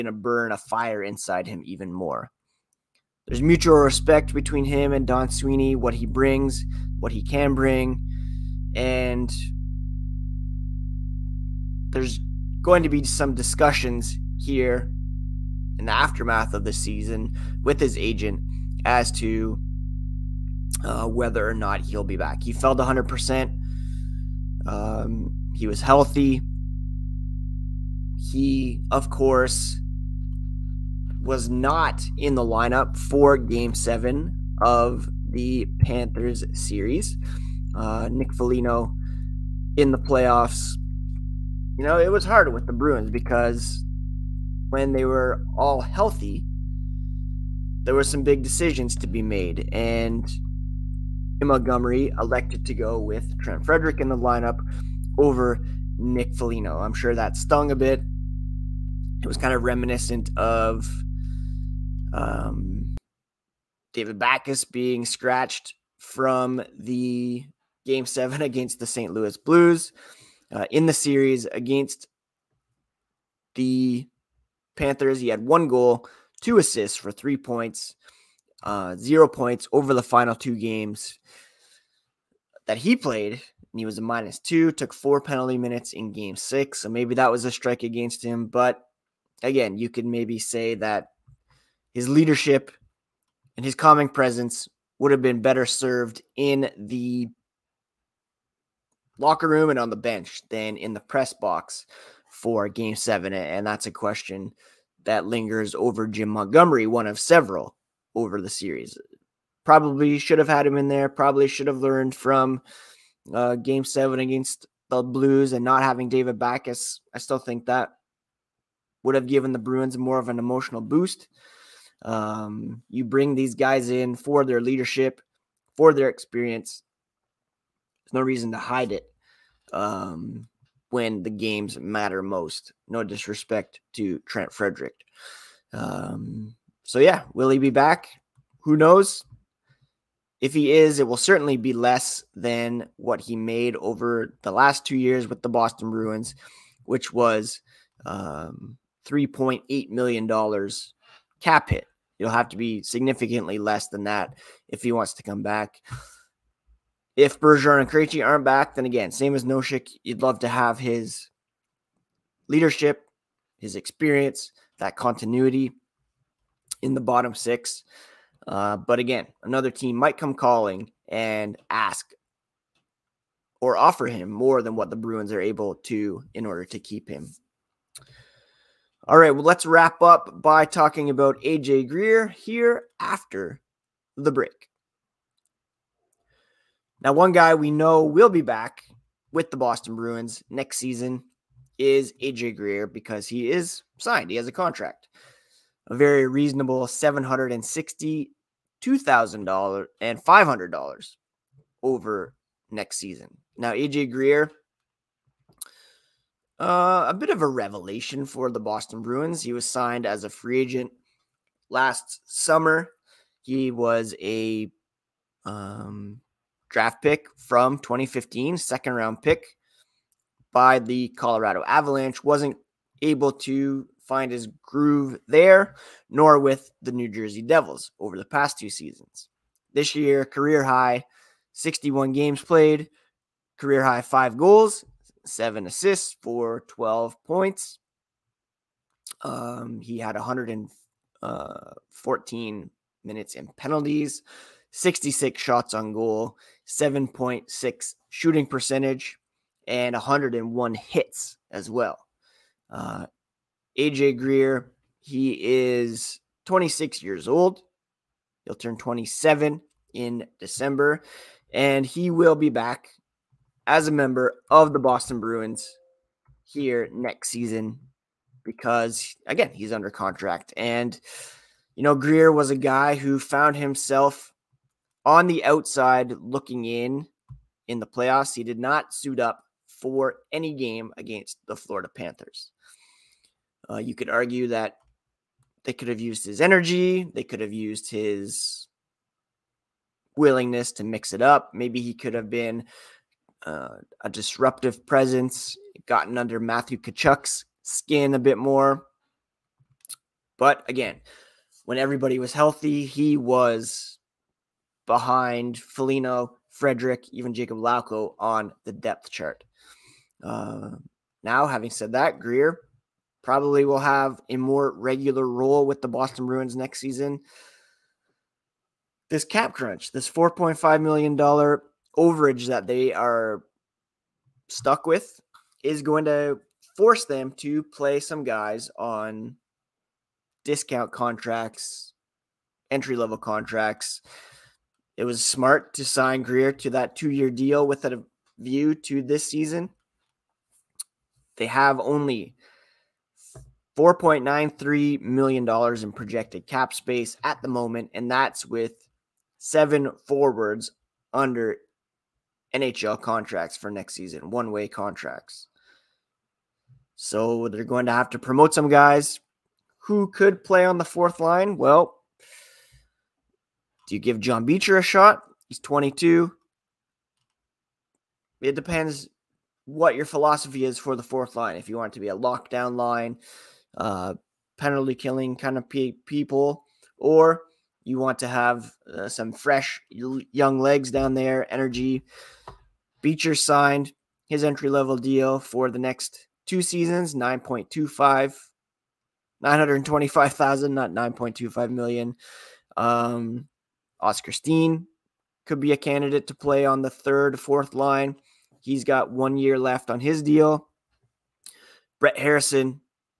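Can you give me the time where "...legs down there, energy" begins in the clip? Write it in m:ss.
6:20.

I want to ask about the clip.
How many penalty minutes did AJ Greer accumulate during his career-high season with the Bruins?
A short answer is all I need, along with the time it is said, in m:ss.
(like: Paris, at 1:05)
114, at 4:00.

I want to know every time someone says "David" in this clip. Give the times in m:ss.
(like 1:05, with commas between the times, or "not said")
1:03, 1:56.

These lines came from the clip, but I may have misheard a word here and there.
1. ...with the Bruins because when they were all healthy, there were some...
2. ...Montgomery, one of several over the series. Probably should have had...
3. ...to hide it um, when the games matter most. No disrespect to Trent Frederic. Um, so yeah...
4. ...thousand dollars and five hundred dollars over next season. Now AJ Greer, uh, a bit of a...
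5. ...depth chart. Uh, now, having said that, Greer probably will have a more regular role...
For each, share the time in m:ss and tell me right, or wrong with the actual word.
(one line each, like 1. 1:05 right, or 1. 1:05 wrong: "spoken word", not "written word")
1. 0:42 right
2. 1:46 right
3. 2:08 right
4. 3:18 right
5. 5:08 right.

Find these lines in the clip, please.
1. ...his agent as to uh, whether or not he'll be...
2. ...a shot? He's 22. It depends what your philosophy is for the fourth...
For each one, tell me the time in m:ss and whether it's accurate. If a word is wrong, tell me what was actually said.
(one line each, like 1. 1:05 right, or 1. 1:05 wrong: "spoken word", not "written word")
1. 0:17 right
2. 6:04 right.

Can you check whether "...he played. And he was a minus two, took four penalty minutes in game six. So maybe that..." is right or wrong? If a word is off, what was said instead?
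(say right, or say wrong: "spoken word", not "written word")
right.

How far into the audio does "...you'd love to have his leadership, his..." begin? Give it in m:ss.
2:40.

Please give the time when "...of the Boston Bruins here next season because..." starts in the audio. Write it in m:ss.
4:24.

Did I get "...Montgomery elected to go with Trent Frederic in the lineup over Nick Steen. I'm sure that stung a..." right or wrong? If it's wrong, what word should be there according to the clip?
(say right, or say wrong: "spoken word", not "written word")
wrong: "Foligno", not "Steen".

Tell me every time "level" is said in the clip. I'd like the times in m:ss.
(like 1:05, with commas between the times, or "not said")
5:32, 6:24.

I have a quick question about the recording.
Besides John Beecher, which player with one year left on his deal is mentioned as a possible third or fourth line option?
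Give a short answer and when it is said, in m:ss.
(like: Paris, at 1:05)
Oskar Steen, at 6:33.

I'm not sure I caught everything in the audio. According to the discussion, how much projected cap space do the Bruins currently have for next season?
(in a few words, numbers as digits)
$4.93 million.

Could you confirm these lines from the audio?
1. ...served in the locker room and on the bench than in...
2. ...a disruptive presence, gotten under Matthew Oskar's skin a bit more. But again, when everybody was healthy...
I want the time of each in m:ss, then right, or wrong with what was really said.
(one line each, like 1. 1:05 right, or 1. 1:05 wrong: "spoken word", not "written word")
1. 1:35 right
2. 4:54 wrong: "Tkachuk", not "Oskar".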